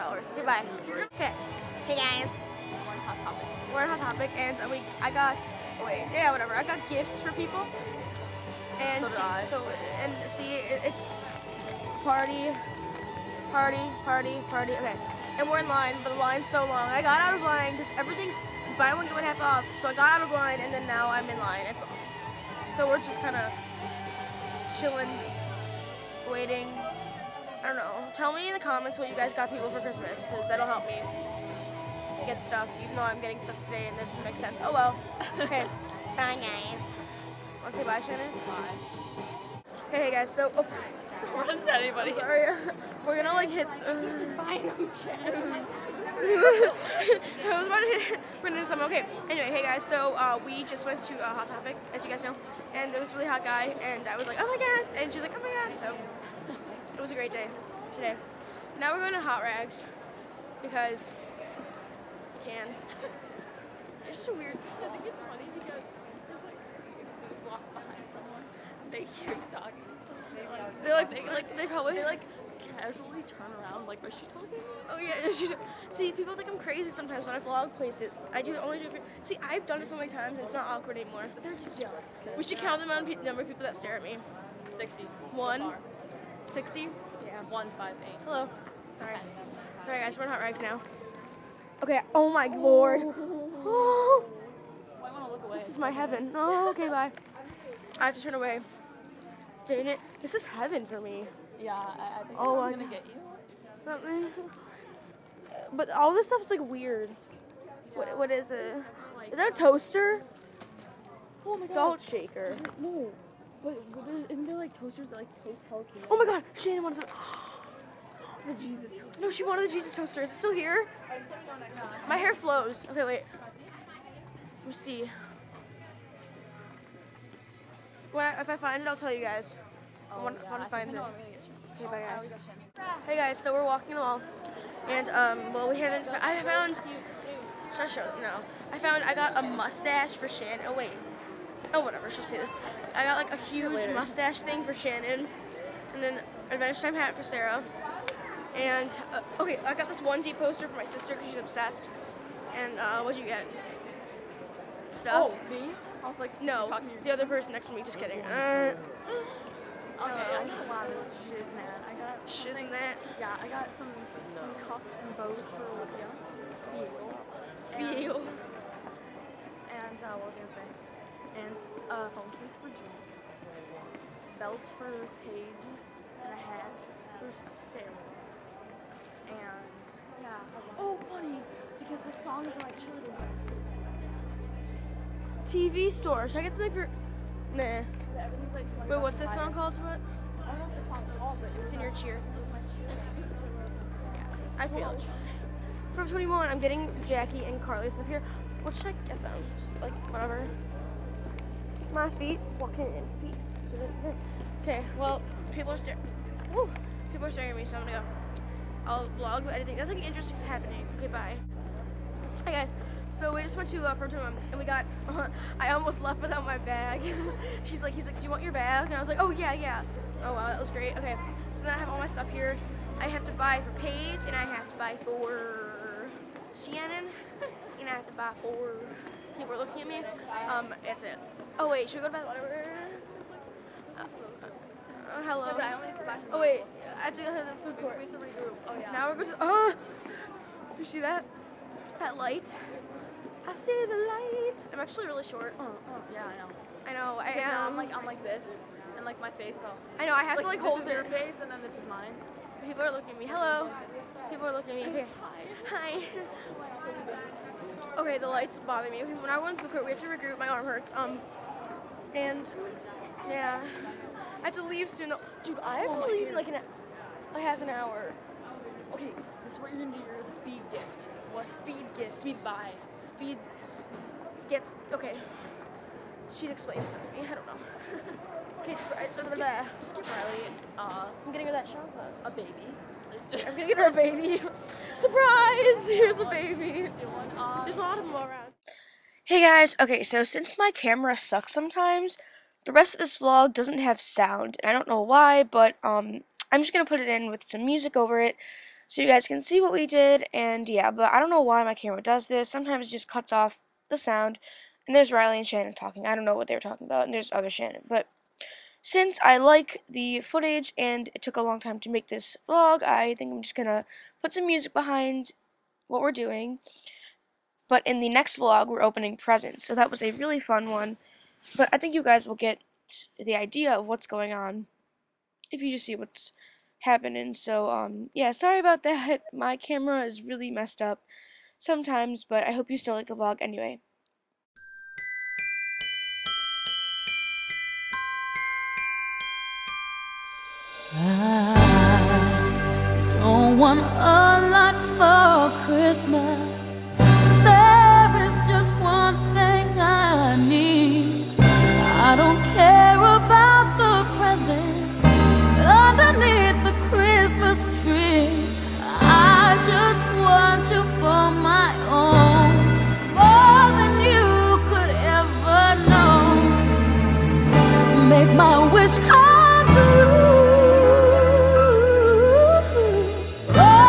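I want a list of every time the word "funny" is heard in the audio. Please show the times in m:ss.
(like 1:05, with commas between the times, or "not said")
1:05, 3:01.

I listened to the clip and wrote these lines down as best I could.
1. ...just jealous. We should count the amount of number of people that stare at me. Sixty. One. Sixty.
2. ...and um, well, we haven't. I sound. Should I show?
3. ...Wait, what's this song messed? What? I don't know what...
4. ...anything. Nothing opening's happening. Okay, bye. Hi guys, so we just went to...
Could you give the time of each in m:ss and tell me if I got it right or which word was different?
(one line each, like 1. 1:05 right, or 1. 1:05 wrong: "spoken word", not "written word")
1. 1:21 right
2. 2:14 wrong: "found", not "sound"
3. 3:08 wrong: "called", not "messed"
4. 3:29 wrong: "interesting", not "opening".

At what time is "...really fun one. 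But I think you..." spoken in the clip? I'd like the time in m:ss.
5:20.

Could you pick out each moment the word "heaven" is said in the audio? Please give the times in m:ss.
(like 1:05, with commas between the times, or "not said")
1:35, 1:40.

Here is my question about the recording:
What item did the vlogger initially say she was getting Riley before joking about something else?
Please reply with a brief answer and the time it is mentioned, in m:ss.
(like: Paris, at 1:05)
Shampoo, at 4:41.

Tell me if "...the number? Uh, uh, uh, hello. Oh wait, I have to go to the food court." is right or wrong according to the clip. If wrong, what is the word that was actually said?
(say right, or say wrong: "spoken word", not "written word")
wrong: "water", not "number".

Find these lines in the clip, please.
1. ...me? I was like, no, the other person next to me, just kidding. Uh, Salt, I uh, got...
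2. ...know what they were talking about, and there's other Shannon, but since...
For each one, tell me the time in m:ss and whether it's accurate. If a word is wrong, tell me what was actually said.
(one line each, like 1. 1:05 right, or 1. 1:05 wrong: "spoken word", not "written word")
1. 2:35 wrong: "Okay", not "Salt"
2. 5:06 right.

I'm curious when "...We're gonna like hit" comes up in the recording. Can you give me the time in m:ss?
0:43.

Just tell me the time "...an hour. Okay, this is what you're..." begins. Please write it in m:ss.
4:27.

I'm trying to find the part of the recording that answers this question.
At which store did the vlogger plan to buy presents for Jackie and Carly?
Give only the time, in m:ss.
3:15.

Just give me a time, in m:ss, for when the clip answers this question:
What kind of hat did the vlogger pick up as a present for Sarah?
2:26.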